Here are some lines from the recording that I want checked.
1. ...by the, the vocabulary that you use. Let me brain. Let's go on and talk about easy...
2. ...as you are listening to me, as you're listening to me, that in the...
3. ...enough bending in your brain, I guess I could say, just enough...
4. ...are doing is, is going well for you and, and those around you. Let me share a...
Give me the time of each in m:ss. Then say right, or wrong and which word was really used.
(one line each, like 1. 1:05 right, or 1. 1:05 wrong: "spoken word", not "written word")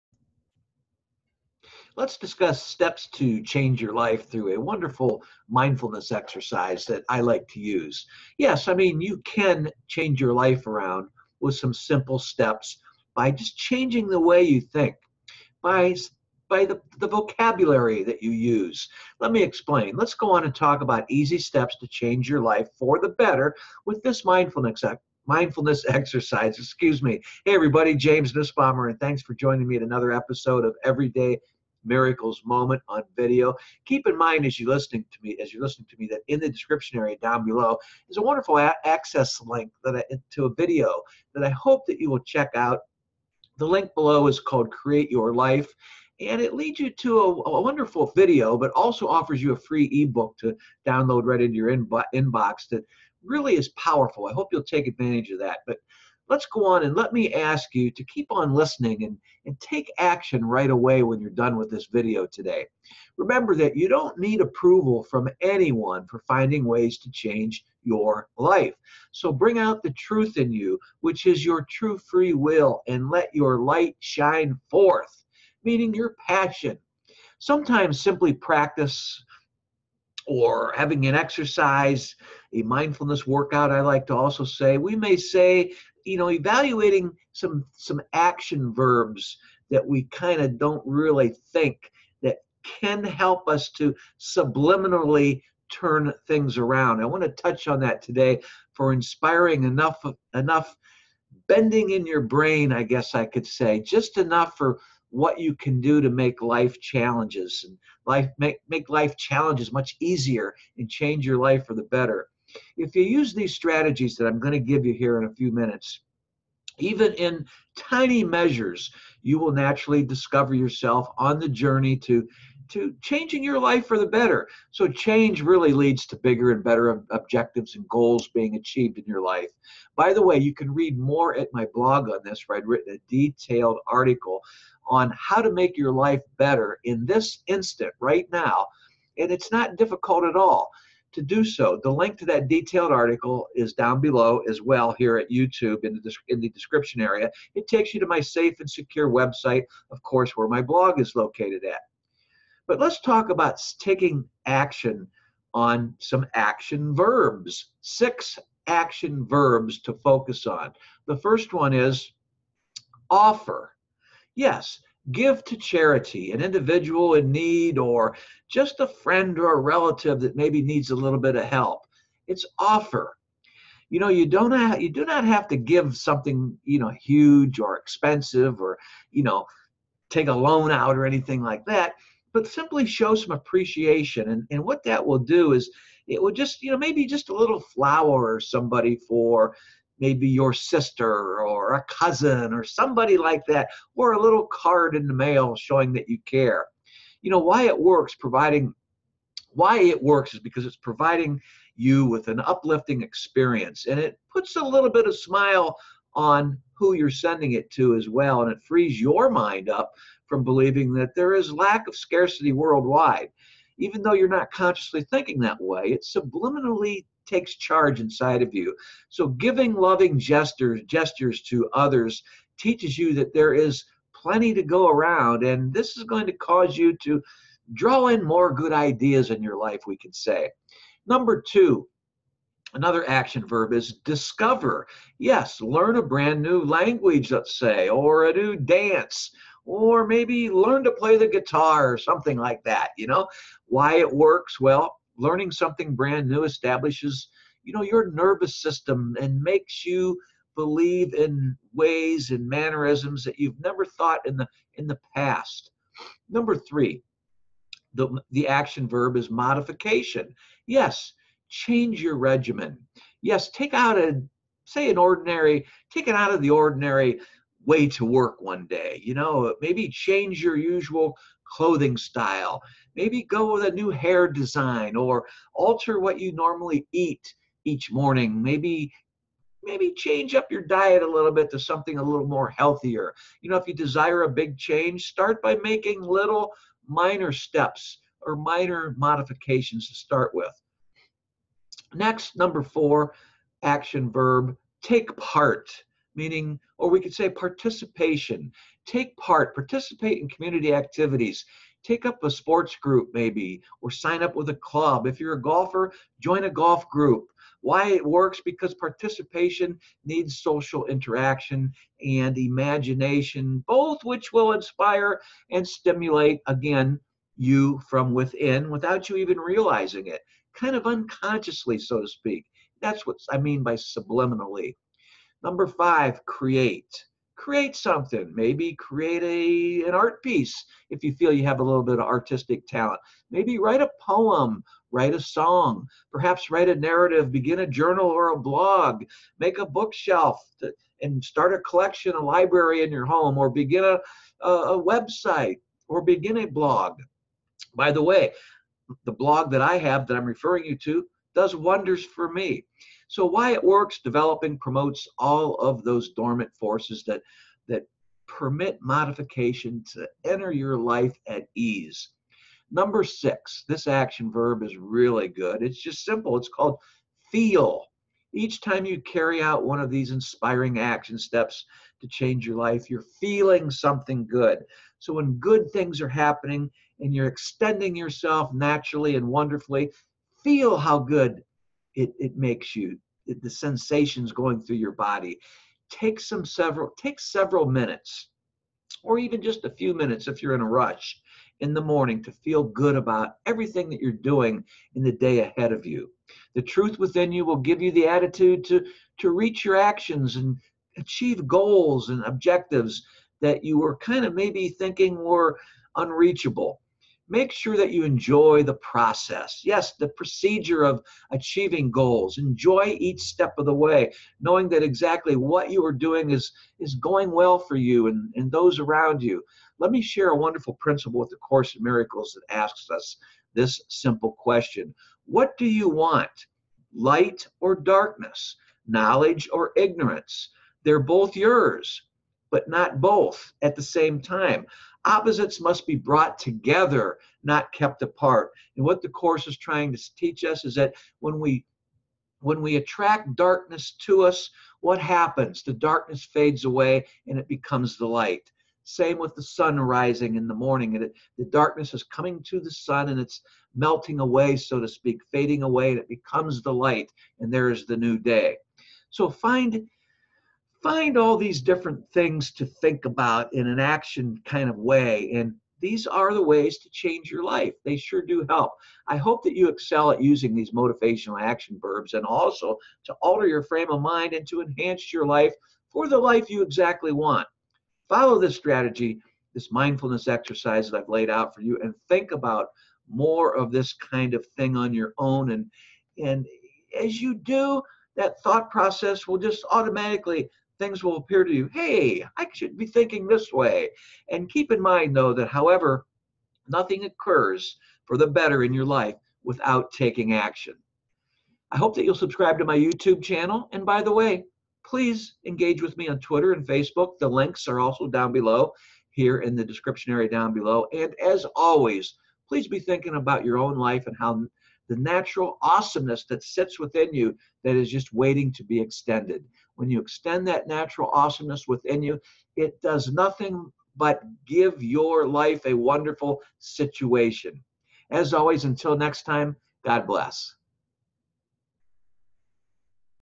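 1. 0:16 wrong: "explain", not "brain"
2. 0:34 right
3. 1:40 right
4. 6:55 right.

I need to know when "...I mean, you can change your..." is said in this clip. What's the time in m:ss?
0:08.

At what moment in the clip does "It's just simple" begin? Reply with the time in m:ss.
6:05.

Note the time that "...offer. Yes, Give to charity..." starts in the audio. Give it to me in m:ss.
2:43.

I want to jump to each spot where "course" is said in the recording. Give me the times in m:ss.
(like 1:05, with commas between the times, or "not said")
2:30, 7:01, 7:19.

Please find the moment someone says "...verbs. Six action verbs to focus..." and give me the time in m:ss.
2:36.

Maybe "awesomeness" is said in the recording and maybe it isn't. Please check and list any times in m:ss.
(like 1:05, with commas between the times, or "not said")
8:35, 8:41.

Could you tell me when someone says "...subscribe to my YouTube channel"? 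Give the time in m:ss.
8:22.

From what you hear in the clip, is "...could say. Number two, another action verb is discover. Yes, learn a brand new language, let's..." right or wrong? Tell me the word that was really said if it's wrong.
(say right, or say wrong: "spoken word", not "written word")
right.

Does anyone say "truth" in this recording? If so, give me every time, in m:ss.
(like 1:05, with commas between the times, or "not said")
1:09, 6:36.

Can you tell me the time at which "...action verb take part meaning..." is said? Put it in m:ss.
4:53.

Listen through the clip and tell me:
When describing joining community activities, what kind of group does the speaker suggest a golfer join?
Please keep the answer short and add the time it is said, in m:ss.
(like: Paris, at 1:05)
Golf group, at 5:06.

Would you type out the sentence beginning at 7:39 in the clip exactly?
So find find all these different things to think about in an action kind of way.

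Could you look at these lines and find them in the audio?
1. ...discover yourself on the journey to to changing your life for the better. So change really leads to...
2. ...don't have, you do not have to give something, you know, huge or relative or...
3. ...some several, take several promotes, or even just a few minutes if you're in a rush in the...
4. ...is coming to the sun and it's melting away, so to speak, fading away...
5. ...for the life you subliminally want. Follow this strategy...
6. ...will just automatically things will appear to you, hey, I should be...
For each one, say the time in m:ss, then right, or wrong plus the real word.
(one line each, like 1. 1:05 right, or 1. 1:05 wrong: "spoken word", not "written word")
1. 2:00 right
2. 2:54 wrong: "expensive", not "relative"
3. 6:26 wrong: "minutes", not "promotes"
4. 7:31 right
5. 7:55 wrong: "exactly", not "subliminally"
6. 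8:09 right.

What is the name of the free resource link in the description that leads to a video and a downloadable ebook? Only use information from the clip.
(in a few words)
Create Your Life.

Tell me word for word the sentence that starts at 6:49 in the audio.
Yes, the procedure of achieving goals.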